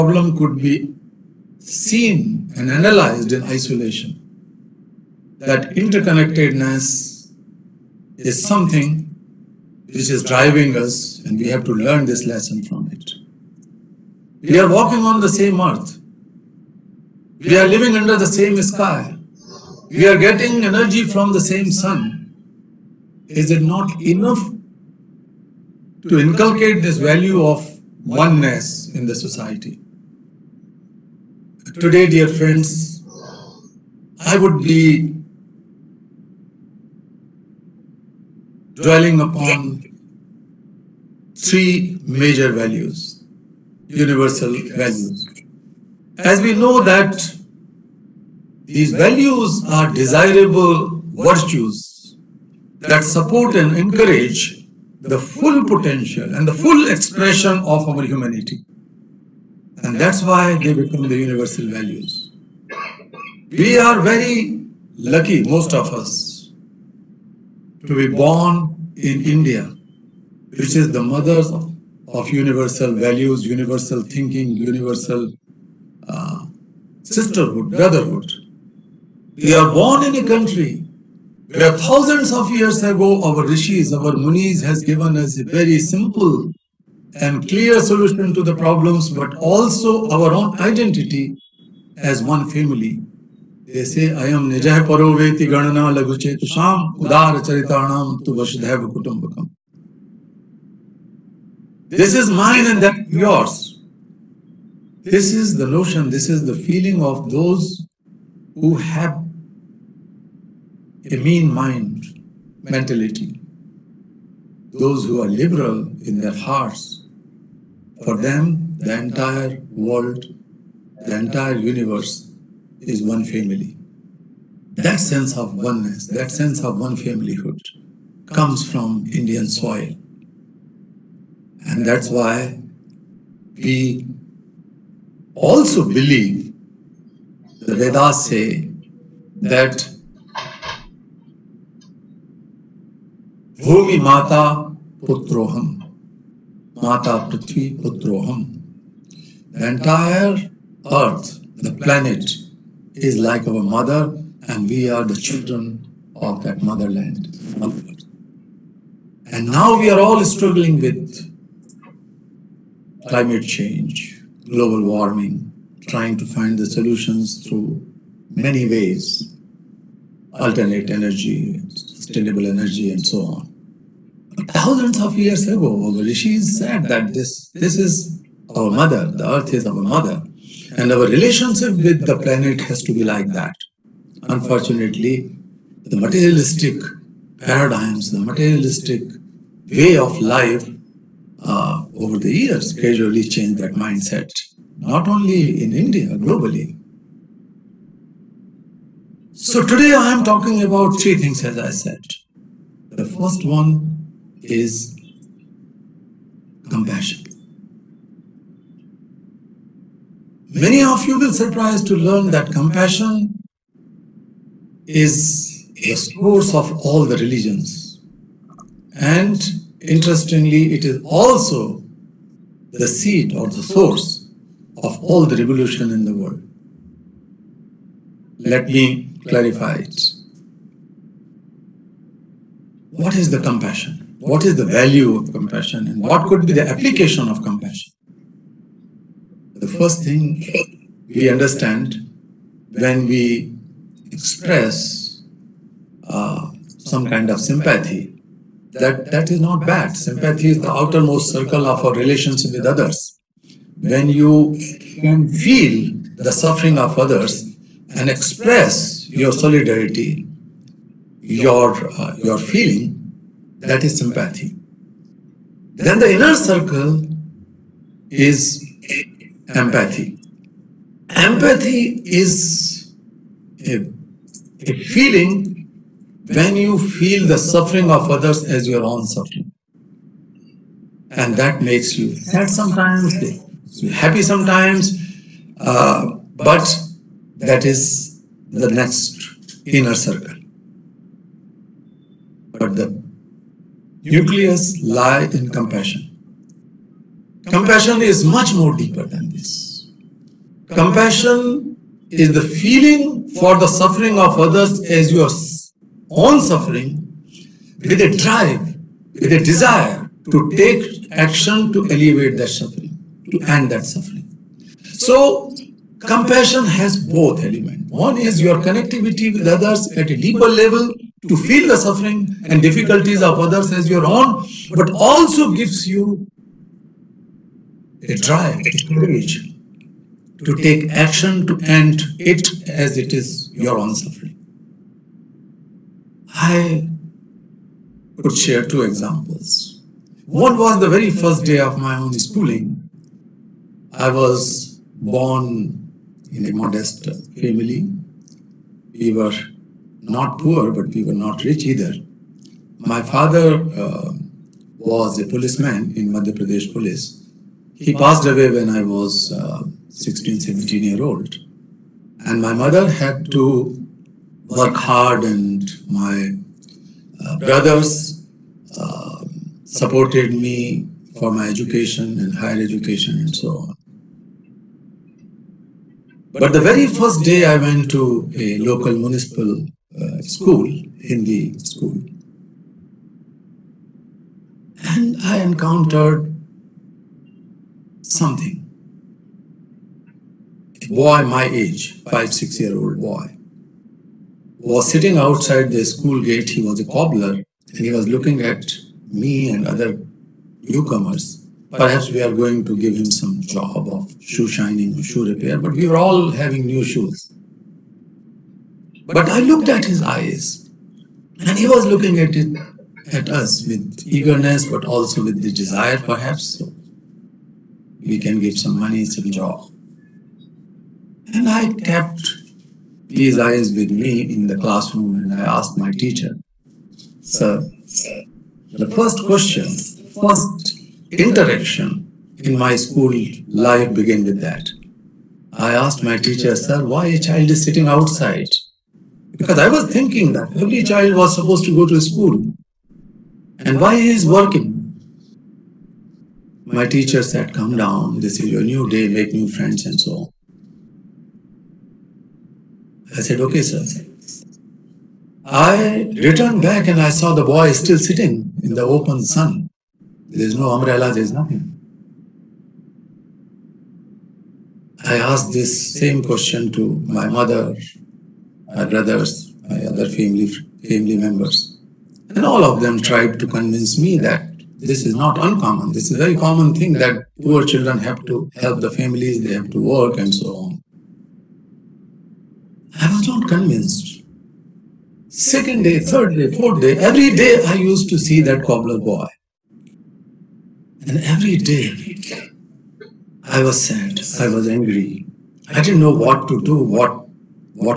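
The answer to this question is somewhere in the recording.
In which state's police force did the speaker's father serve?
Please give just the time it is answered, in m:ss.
5:56.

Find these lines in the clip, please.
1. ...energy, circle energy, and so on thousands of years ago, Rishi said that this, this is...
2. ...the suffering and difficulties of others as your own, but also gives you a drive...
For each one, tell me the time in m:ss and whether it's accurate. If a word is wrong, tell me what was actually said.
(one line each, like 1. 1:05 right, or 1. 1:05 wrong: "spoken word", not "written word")
1. 2:51 wrong: "sustainable", not "circle"
2. 5:21 right.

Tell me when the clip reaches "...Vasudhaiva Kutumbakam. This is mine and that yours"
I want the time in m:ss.
1:38.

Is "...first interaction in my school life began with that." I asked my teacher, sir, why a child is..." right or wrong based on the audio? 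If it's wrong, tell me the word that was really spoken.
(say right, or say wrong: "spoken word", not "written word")
right.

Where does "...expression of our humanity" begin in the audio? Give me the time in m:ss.
0:56.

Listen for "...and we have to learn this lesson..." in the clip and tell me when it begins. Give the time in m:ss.
0:11.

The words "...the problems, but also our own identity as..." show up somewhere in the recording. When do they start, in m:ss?
1:28.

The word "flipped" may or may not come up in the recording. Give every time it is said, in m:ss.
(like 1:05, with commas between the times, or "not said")
not said.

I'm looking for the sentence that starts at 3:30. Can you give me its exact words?
Many of you will surprise to learn that compassion is a source of all the religions.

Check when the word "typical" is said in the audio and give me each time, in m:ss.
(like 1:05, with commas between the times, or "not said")
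not said.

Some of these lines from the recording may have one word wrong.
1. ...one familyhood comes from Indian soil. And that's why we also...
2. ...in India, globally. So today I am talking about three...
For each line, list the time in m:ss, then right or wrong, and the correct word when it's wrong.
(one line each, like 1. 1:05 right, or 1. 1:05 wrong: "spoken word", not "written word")
1. 2:06 right
2. 3:15 right.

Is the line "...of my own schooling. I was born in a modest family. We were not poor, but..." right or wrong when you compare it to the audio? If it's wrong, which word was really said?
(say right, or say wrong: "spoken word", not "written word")
right.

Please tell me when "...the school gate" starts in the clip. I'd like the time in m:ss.
6:35.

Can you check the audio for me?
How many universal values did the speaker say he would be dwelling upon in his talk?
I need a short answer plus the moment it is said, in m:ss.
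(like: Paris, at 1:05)
3, at 0:41.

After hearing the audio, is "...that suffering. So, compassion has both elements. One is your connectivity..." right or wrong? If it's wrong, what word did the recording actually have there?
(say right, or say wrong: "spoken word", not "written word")
right.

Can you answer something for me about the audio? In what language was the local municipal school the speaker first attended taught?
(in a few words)
Hindi.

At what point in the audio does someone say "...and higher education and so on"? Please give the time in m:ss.
6:12.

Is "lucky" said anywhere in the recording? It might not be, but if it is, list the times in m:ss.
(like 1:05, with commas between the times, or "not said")
1:04.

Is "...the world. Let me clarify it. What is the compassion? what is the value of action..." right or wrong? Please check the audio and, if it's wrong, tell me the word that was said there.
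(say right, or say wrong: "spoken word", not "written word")
wrong: "compassion", not "action".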